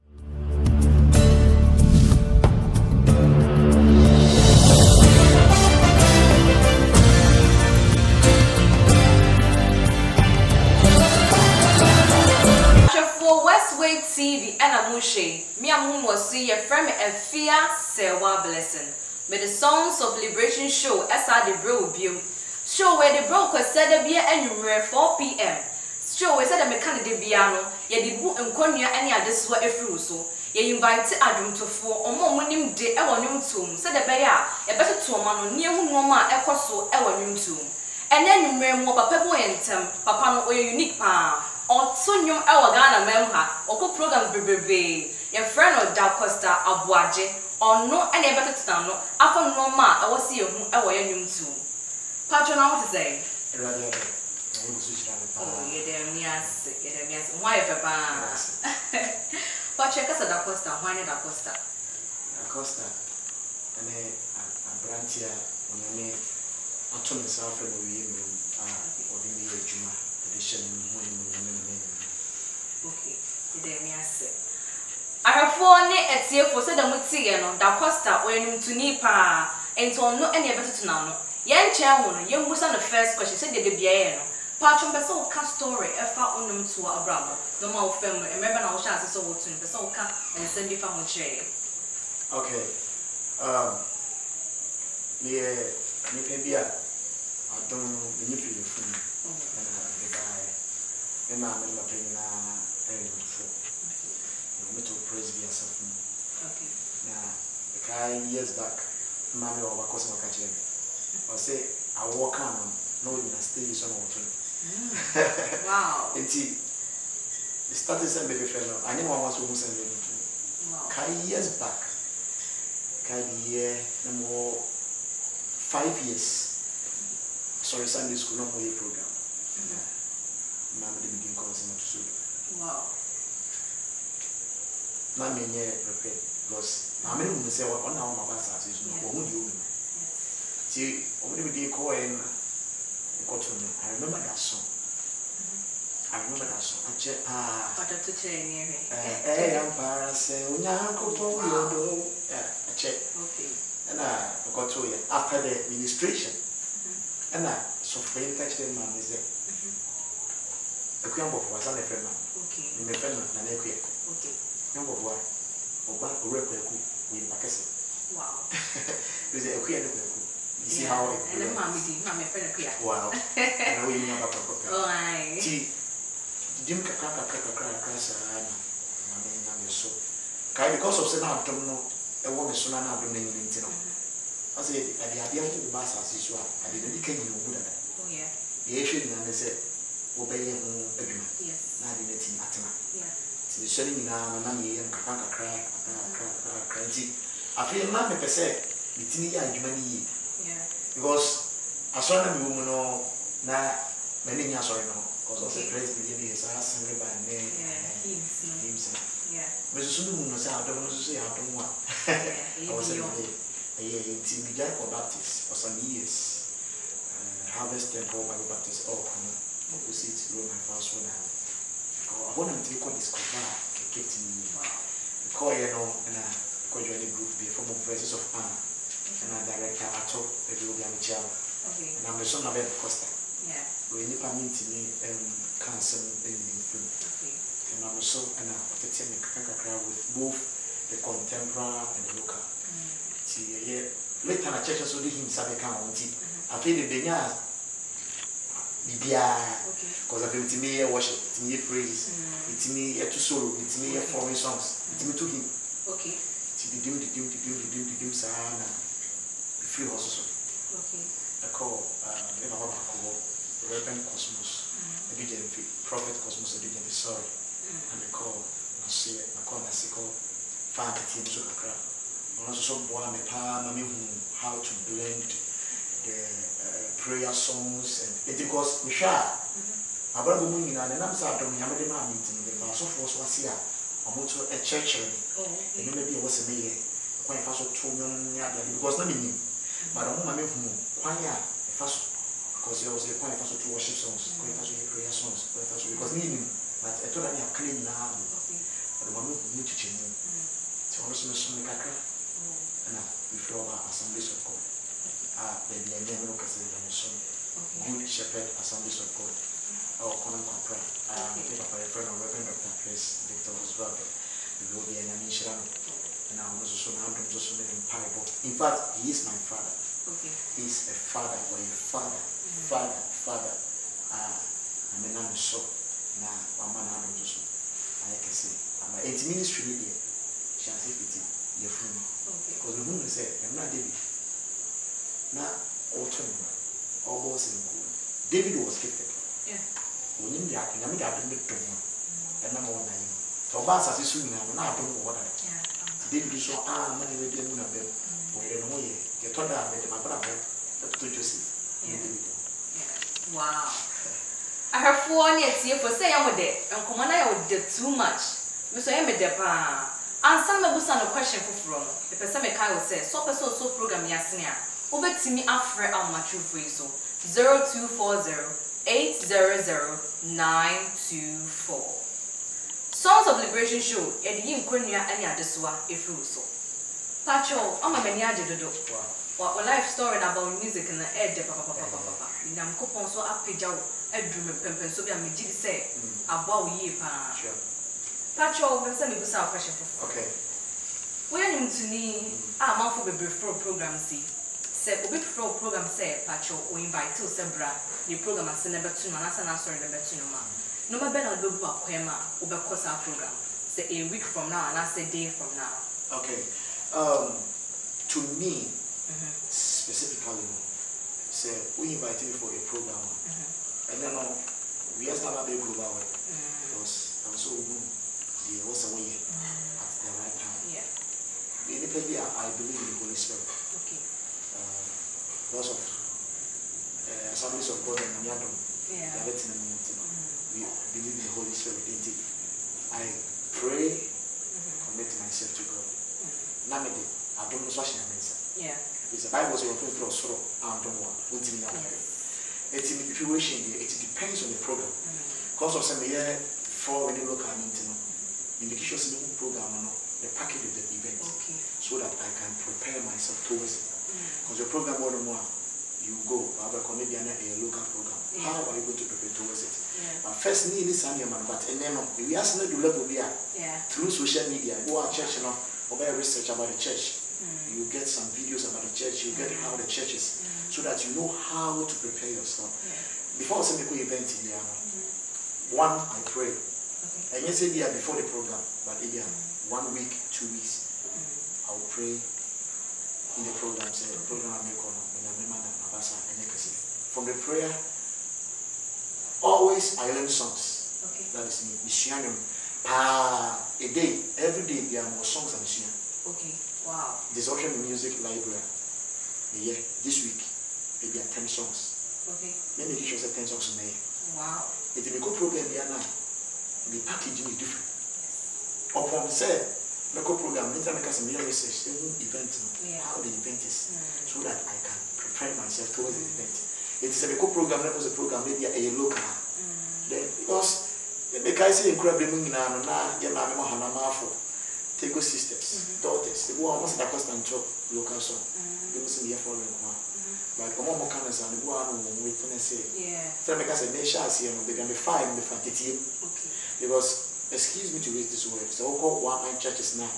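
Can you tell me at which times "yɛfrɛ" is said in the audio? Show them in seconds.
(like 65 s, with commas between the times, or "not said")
16 s, 311 s.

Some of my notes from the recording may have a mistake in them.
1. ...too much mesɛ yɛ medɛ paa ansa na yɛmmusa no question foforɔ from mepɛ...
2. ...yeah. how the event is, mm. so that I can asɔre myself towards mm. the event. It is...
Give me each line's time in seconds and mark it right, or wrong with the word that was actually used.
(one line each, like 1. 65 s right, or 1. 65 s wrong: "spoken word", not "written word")
1. 357 s wrong: "mabusa", not "yɛmmusa"
2. 512 s wrong: "prepare", not "asɔre".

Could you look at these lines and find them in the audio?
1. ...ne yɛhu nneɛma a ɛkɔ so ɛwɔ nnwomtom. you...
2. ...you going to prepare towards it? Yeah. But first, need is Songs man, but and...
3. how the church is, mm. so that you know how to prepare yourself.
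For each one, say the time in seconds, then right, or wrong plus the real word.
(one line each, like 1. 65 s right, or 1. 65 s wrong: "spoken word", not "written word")
1. 35 s right
2. 458 s wrong: "Sanya", not "Songs"
3. 469 s right.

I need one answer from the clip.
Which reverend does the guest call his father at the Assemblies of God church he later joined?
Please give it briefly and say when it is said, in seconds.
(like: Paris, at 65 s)
Chris Victor, at 312 s.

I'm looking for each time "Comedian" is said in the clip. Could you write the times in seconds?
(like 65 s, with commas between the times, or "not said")
456 s.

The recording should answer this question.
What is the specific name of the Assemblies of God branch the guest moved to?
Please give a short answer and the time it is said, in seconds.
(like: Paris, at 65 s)
Shepherd Assemblies of God, at 308 s.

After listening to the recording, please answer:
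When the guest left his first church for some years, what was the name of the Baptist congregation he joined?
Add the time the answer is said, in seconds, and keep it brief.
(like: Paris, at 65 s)
Harvest Temple Bible Baptist, at 217 s.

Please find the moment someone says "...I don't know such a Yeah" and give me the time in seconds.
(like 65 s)
437 s.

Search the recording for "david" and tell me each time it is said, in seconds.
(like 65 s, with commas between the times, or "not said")
338 s, 346 s, 351 s.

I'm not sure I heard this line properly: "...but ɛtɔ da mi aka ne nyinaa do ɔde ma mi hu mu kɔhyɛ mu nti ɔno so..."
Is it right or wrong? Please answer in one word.
wrong.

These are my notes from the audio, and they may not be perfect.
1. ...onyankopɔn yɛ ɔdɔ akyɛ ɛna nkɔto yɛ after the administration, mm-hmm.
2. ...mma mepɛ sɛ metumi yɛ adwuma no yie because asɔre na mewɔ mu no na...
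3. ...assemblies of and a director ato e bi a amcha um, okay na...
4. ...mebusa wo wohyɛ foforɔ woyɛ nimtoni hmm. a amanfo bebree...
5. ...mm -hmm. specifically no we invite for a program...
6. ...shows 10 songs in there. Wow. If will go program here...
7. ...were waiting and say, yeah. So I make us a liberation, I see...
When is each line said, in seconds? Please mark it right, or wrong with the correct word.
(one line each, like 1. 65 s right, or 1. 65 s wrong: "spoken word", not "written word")
1. 150 s right
2. 197 s right
3. 227 s wrong: "verses", not "assemblies"
4. 389 s wrong: "kɔhyɛ", not "wohyɛ"
5. 408 s right
6. 503 s right
7. 531 s wrong: "nation", not "liberation".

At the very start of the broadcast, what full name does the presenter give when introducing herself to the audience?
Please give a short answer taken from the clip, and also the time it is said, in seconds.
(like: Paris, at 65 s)
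Efia Sewa Blessing, at 16 s.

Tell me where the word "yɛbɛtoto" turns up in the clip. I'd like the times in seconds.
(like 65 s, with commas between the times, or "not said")
34 s, 80 s.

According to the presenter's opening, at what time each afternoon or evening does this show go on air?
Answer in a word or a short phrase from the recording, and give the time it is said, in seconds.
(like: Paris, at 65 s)
4pm, at 24 s.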